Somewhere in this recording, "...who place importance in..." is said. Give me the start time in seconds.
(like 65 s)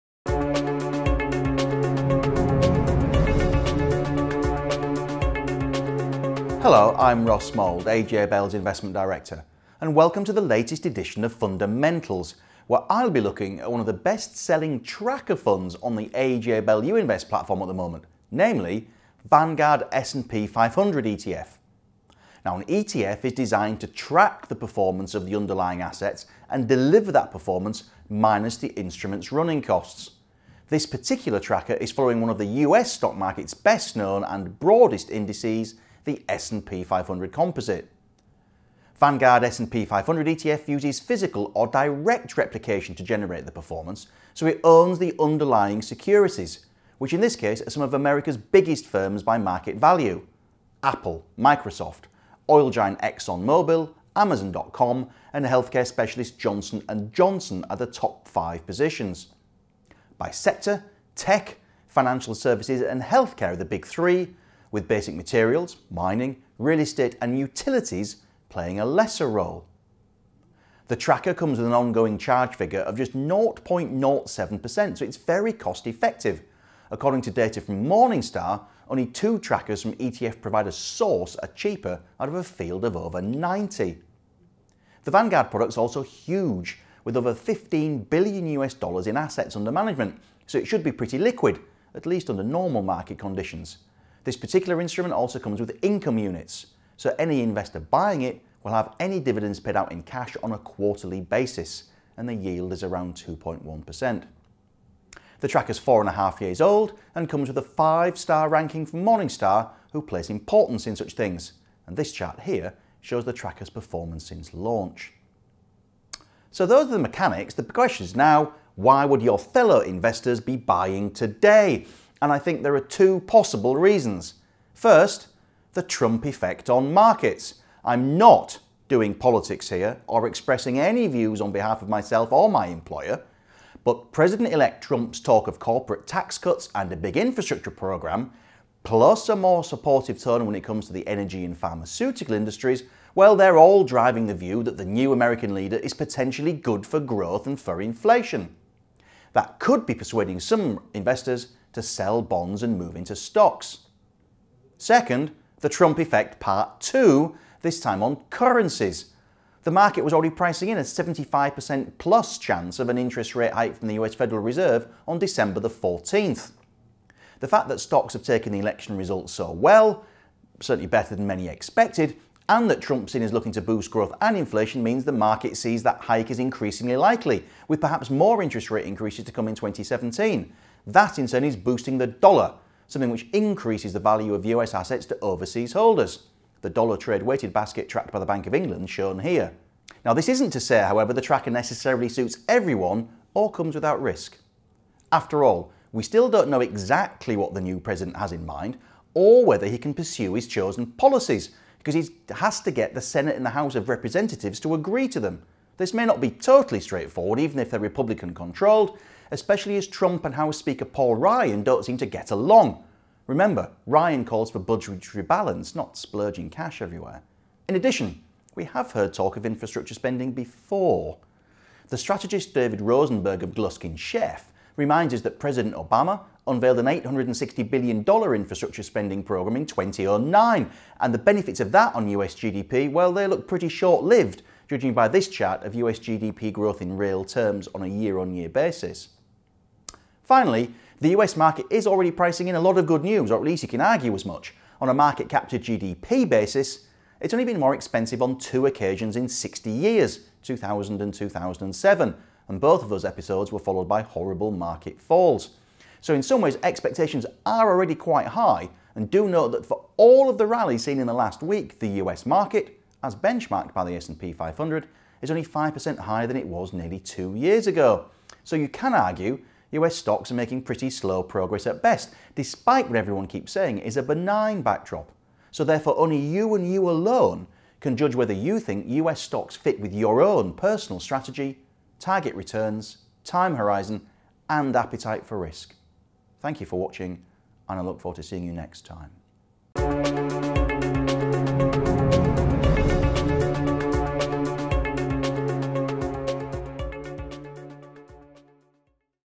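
109 s.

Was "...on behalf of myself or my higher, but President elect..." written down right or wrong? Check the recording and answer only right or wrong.
wrong.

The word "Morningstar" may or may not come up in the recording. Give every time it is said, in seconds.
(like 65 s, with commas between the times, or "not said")
77 s, 109 s.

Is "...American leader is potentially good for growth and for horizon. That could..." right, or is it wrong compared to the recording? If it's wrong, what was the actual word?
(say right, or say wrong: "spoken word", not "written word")
wrong: "inflation", not "horizon".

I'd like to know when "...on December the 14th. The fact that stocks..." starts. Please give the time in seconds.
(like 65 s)
165 s.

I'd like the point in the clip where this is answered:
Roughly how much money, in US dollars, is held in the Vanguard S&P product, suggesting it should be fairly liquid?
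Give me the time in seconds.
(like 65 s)
87 s.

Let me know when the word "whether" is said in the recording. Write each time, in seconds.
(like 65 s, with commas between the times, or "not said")
199 s, 278 s.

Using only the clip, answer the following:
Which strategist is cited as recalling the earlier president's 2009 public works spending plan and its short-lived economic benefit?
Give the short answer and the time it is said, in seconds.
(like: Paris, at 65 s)
David Rosenberg, at 222 s.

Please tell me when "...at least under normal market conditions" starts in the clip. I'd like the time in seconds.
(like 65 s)
91 s.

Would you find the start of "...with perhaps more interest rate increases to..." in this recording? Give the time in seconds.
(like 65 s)
177 s.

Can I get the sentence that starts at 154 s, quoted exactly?
Second, the Trump effect part two, this time on currencies.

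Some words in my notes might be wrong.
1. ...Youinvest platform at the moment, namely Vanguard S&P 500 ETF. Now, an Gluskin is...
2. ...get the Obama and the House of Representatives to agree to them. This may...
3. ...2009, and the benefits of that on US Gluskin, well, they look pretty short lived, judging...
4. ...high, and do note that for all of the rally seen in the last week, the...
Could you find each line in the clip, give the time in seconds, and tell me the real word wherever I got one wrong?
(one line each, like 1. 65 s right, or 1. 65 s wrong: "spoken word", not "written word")
1. 16 s wrong: "ETF", not "Gluskin"
2. 202 s wrong: "Senate", not "Obama"
3. 229 s wrong: "GDP", not "Gluskin"
4. 258 s right.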